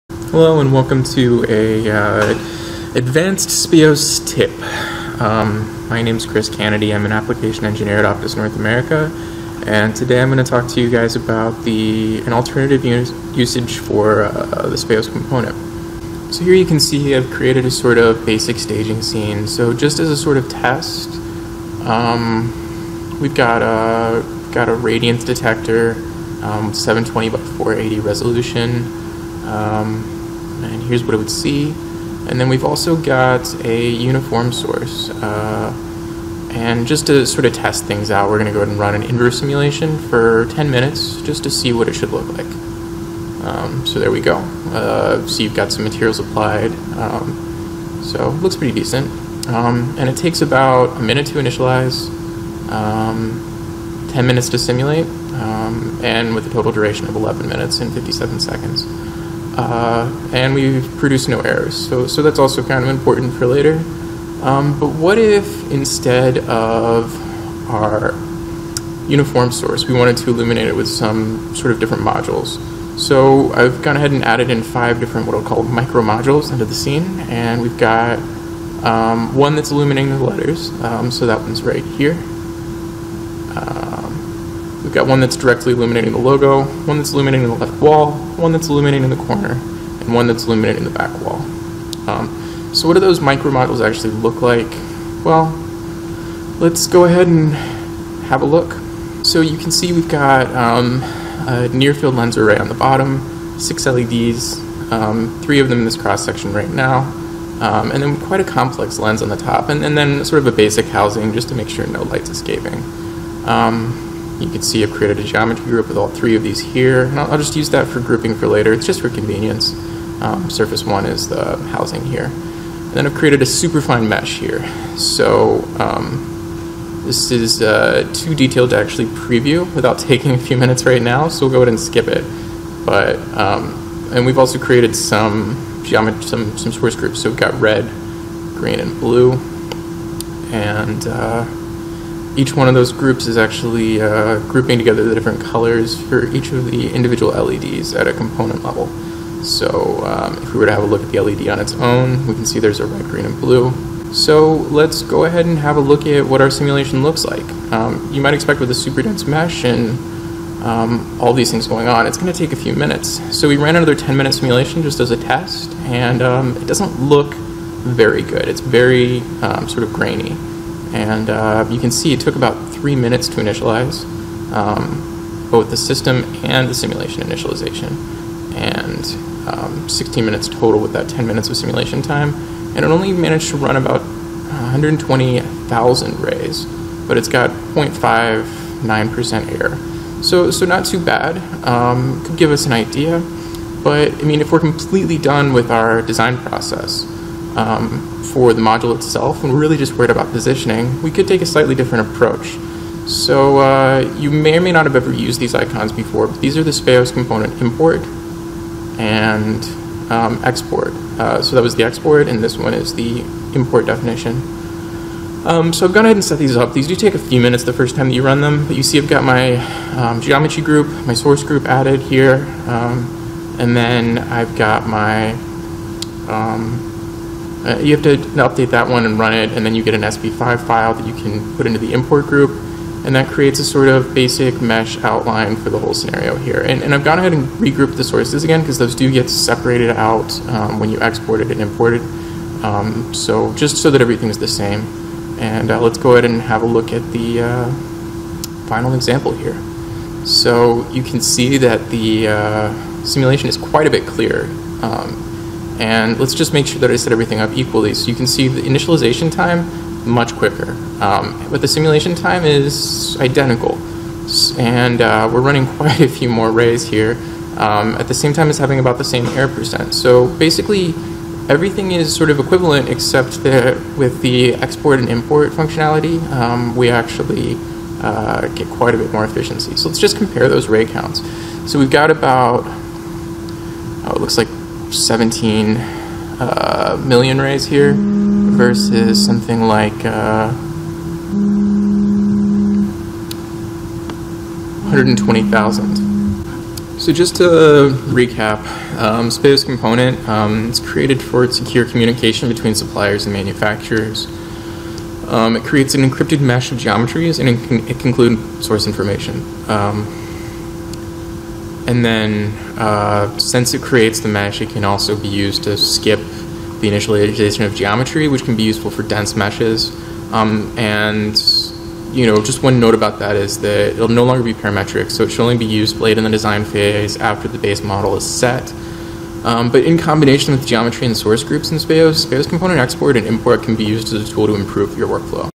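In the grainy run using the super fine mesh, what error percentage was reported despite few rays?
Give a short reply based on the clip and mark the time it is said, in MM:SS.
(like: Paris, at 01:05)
0.59%, at 03:07.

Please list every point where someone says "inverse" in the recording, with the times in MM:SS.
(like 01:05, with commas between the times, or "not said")
00:39.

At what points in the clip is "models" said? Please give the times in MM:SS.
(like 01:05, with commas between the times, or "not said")
01:33, 05:27.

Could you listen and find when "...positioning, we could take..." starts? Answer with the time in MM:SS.
03:20.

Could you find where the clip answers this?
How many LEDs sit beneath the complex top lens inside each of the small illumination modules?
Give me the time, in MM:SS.
01:43.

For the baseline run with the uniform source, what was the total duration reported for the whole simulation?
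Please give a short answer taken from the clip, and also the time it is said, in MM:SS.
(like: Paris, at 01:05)
11 minutes and 57 seconds, at 00:57.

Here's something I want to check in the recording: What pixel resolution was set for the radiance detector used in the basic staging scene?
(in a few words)
720 by 480.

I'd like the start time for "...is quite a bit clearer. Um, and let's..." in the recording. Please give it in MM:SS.
04:13.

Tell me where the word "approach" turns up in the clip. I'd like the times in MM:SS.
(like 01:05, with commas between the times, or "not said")
03:22.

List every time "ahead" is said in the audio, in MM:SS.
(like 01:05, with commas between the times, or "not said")
00:38, 01:13, 01:37, 02:11, 02:35, 03:36, 03:57, 04:06.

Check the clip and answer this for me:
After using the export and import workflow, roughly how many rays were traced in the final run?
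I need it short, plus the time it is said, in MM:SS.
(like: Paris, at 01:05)
17 million, at 04:44.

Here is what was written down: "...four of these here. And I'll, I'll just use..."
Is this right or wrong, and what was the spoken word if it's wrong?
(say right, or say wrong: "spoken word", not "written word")
wrong: "three", not "four".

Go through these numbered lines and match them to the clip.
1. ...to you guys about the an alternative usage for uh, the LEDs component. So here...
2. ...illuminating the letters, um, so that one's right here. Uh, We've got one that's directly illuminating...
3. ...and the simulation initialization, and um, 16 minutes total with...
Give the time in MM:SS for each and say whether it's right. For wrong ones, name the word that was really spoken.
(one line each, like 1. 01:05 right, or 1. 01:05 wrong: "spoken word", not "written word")
1. 00:10 wrong: "Speos", not "LEDs"
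2. 01:19 right
3. 02:56 right.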